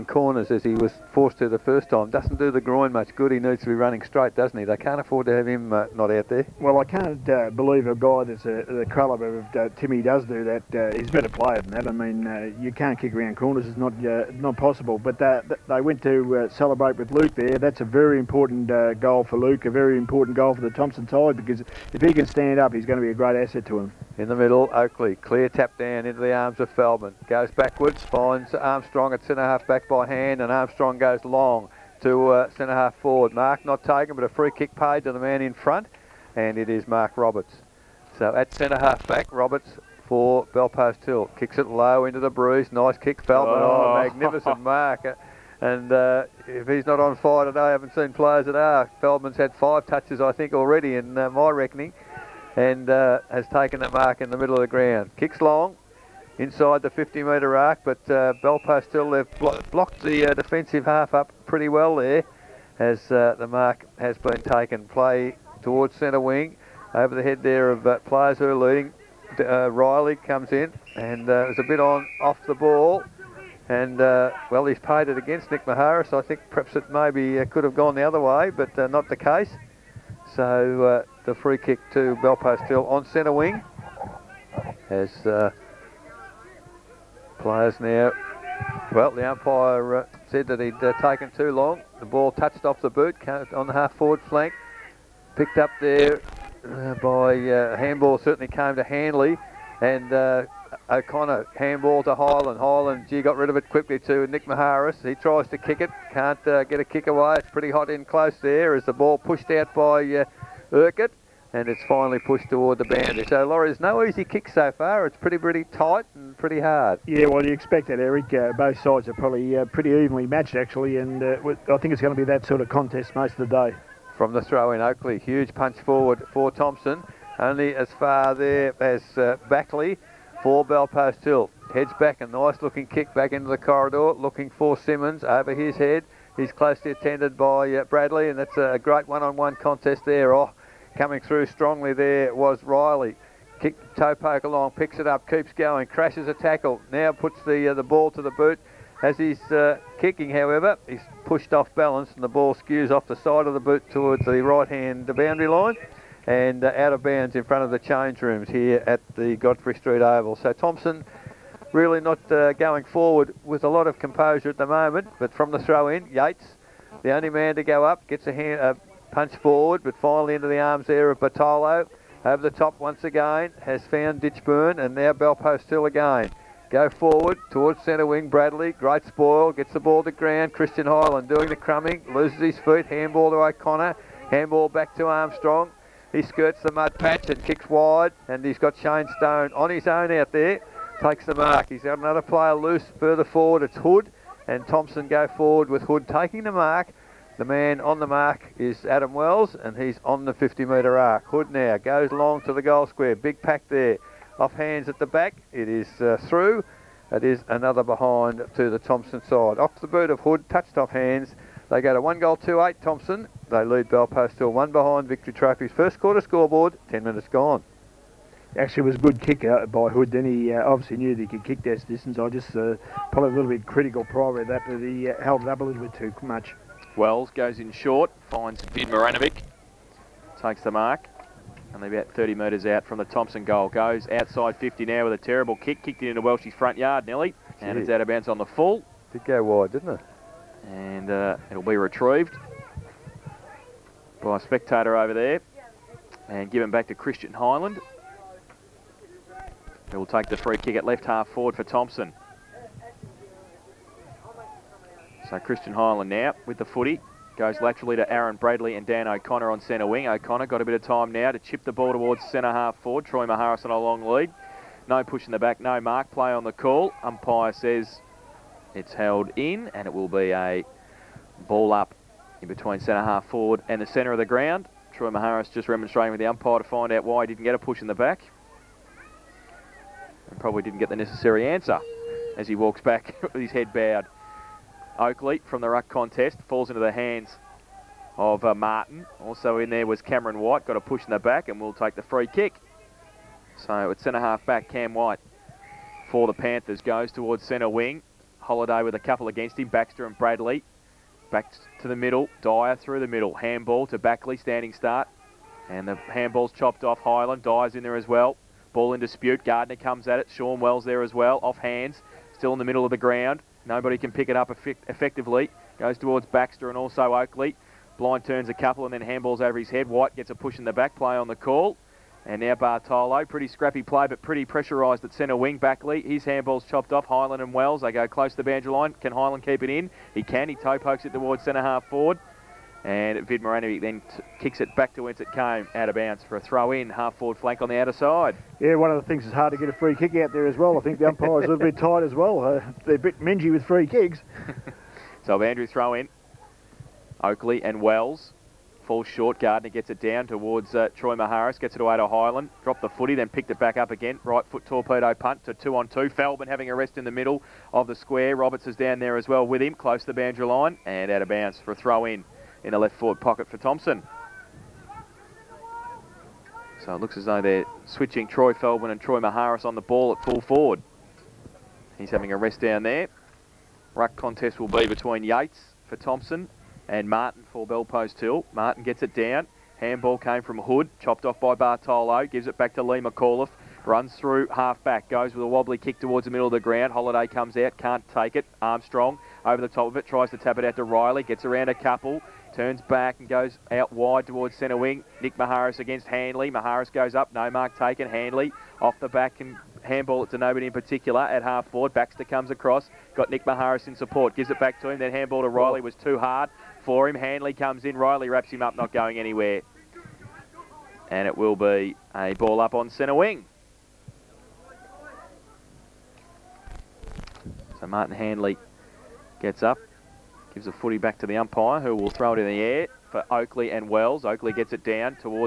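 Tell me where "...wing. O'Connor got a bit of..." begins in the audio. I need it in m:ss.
4:19.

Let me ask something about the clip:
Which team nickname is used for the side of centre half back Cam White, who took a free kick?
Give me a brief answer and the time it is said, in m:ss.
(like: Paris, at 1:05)
Panthers, at 4:56.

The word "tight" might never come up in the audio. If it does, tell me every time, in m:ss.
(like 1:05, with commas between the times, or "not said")
1:55, 5:41.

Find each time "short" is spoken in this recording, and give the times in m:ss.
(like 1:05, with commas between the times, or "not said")
3:47, 5:49.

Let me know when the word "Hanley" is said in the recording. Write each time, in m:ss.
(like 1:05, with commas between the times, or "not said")
1:38, 6:47.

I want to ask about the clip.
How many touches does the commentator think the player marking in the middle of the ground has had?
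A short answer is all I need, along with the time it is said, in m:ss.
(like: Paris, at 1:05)
5, at 0:49.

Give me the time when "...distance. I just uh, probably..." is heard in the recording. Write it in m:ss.
3:41.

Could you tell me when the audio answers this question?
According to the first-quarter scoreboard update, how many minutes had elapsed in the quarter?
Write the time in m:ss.
3:36.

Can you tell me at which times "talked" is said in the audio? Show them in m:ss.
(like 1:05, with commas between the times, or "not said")
not said.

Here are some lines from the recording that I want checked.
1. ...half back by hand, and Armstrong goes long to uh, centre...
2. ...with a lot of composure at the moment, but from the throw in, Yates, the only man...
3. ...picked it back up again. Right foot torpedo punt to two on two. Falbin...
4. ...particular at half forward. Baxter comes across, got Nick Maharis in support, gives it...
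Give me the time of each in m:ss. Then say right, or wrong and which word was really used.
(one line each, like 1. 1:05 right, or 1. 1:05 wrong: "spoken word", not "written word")
1. 0:29 right
2. 2:43 right
3. 5:53 right
4. 6:40 right.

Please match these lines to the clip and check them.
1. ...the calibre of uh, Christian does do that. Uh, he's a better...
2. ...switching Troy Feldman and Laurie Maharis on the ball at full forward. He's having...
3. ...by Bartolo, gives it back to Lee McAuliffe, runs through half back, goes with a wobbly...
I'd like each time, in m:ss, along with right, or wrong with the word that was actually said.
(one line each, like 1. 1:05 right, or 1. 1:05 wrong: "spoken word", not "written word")
1. 0:08 wrong: "Timmy", not "Christian"
2. 6:07 wrong: "Troy", not "Laurie"
3. 6:21 right.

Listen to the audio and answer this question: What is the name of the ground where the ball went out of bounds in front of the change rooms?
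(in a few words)
Godfrey Street Oval.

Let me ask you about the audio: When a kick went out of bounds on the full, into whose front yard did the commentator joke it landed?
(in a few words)
Welsh's.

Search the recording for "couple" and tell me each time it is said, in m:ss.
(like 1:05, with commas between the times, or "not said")
4:58, 5:18, 6:31.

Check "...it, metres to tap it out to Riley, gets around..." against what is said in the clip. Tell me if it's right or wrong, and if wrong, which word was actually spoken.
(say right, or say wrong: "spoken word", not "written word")
wrong: "tries", not "metres".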